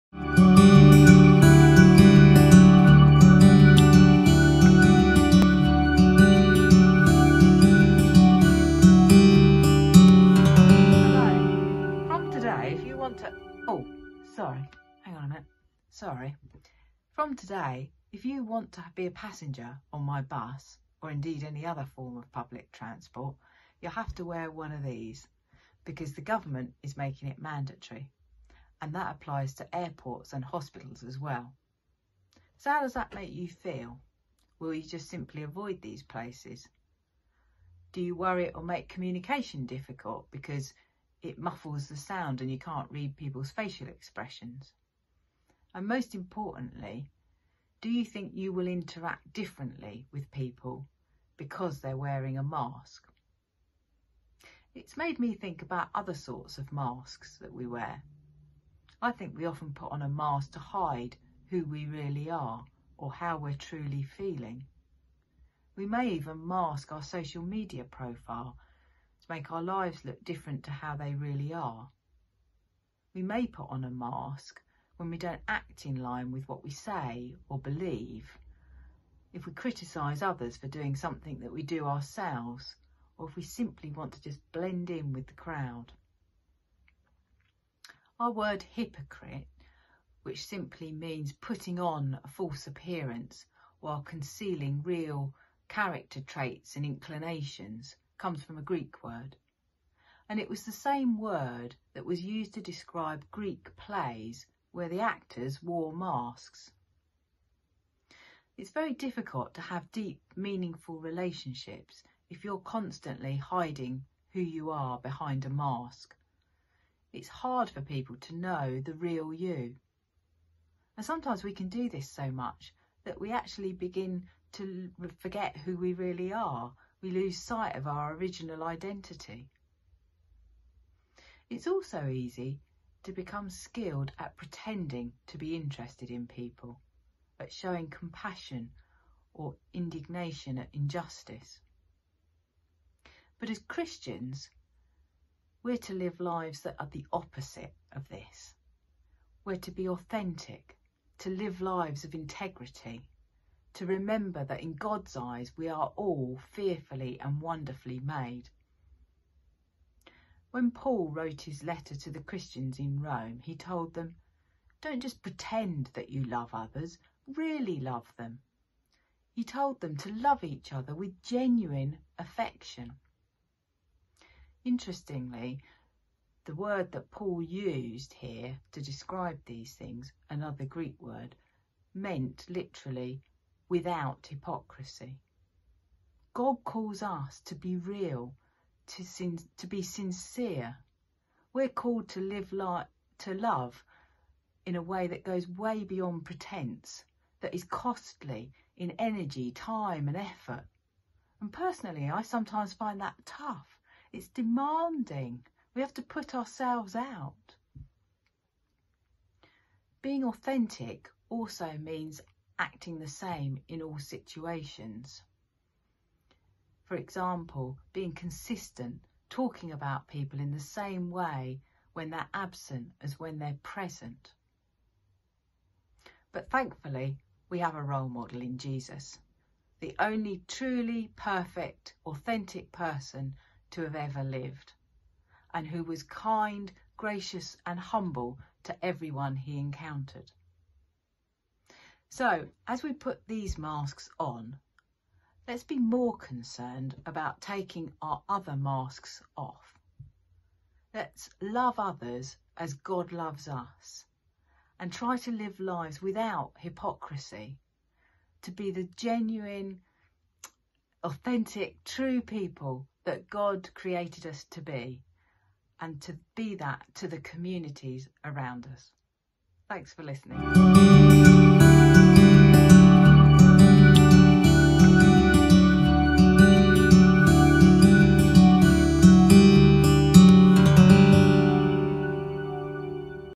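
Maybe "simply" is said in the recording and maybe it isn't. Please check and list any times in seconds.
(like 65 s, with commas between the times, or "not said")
35 s, 83 s, 90 s.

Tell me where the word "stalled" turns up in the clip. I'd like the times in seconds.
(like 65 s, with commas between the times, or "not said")
not said.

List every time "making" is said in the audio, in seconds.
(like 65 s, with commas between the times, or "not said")
26 s.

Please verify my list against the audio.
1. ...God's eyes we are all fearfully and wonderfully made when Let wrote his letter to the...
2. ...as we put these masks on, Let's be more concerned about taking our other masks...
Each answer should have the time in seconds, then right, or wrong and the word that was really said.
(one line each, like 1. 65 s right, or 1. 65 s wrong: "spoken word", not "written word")
1. 154 s wrong: "Paul", not "Let"
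2. 242 s right.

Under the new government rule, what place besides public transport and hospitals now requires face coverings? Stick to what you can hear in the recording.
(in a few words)
Airports.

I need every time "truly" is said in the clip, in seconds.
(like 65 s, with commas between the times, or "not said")
63 s, 230 s.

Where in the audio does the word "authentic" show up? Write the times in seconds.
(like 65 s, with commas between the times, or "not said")
149 s, 210 s, 232 s, 261 s.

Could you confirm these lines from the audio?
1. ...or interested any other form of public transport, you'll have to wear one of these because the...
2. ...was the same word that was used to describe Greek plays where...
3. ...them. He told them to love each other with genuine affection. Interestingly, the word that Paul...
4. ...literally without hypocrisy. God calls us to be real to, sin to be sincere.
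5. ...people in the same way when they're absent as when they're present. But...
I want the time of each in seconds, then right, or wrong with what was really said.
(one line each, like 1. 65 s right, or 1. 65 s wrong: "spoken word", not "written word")
1. 20 s wrong: "indeed", not "interested"
2. 100 s right
3. 168 s right
4. 182 s right
5. 220 s right.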